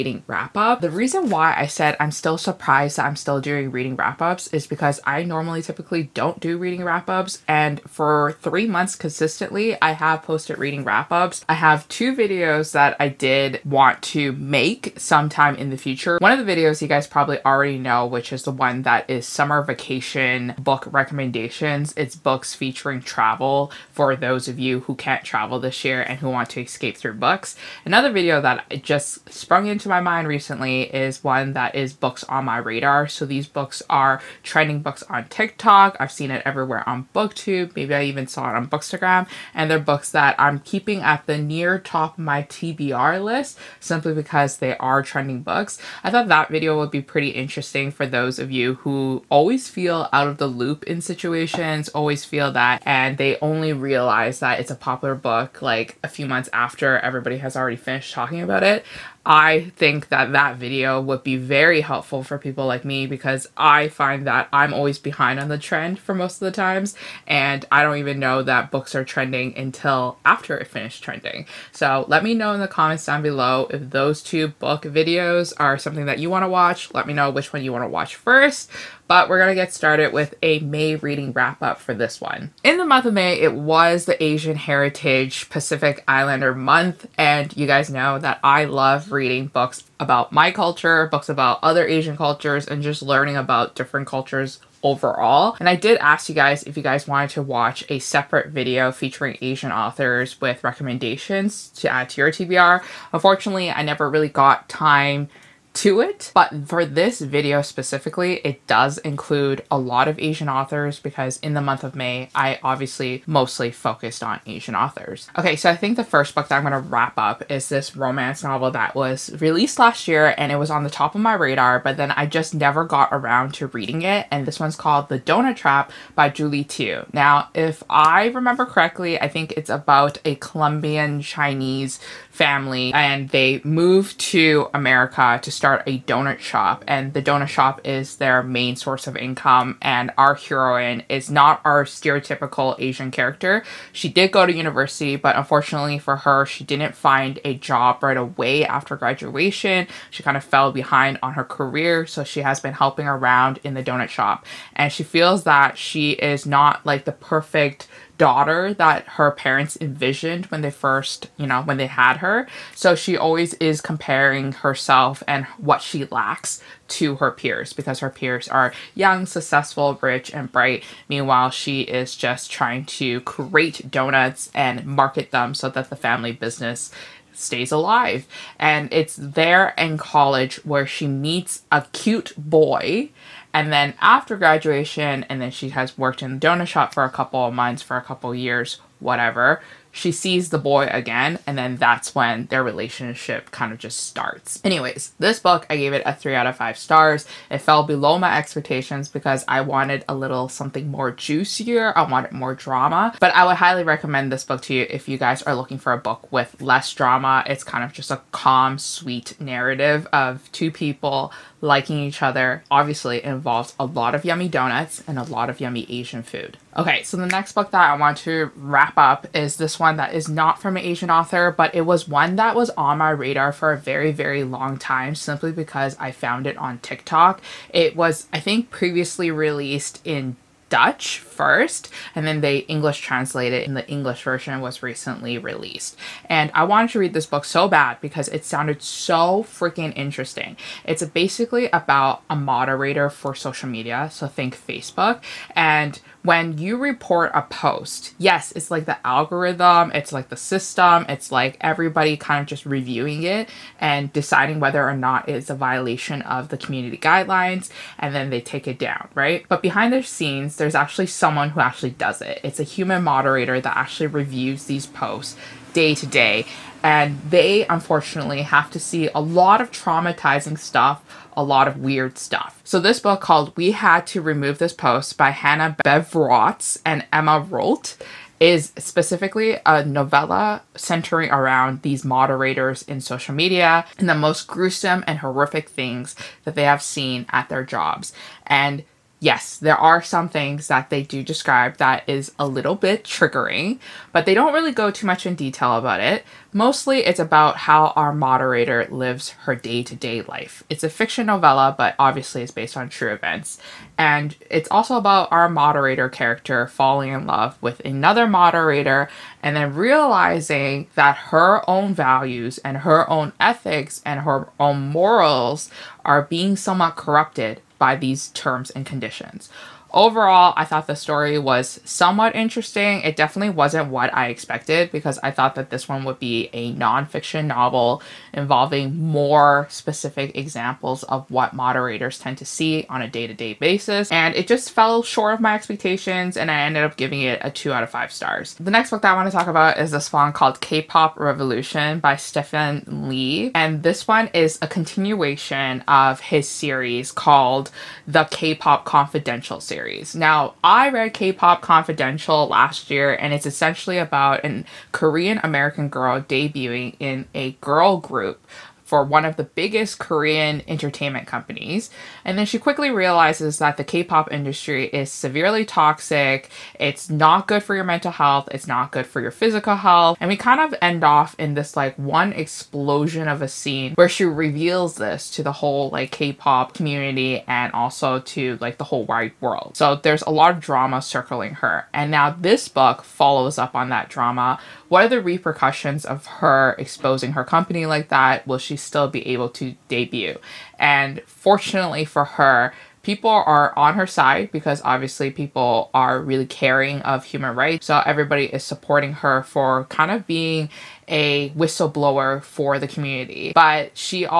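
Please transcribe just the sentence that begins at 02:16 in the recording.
And the donut shop is their main source of income.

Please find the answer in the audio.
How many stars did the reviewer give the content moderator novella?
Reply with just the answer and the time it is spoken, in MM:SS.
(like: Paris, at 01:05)
2 out of 5, at 05:37.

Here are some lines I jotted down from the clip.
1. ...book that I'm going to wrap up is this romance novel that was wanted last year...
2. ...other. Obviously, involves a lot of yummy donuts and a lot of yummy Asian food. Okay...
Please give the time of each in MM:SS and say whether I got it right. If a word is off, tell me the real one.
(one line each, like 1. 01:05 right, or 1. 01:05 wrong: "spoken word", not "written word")
1. 01:56 wrong: "released", not "wanted"
2. 03:32 right.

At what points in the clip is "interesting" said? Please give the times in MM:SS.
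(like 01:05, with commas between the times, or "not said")
00:47, 03:59, 05:22.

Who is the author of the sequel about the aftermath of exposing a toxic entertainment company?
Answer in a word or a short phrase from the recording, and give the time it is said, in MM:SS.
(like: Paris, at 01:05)
Stephan Lee, at 05:42.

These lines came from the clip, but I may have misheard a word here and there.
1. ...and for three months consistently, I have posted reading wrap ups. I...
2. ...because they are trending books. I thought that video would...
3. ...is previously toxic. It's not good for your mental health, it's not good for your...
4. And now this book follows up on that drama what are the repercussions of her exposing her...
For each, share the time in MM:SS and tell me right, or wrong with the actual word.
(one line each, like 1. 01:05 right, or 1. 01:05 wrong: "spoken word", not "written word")
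1. 00:07 right
2. 00:44 right
3. 06:04 wrong: "severely", not "previously"
4. 06:21 right.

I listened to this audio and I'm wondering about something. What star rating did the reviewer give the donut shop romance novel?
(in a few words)
3 out of 5.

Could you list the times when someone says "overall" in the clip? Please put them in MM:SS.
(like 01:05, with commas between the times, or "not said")
01:34, 05:19.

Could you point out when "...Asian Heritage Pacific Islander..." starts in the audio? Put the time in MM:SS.
01:24.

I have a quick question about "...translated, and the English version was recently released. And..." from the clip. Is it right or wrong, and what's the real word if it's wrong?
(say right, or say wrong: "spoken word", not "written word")
right.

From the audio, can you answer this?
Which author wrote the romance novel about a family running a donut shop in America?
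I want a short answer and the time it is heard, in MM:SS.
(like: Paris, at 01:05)
Julie Tieu, at 02:06.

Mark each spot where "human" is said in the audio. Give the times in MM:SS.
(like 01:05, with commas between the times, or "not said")
04:22, 06:37.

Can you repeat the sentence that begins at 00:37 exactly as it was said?
Maybe I even saw it on Bookstagram.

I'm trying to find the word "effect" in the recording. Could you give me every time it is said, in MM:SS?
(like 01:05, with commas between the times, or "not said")
not said.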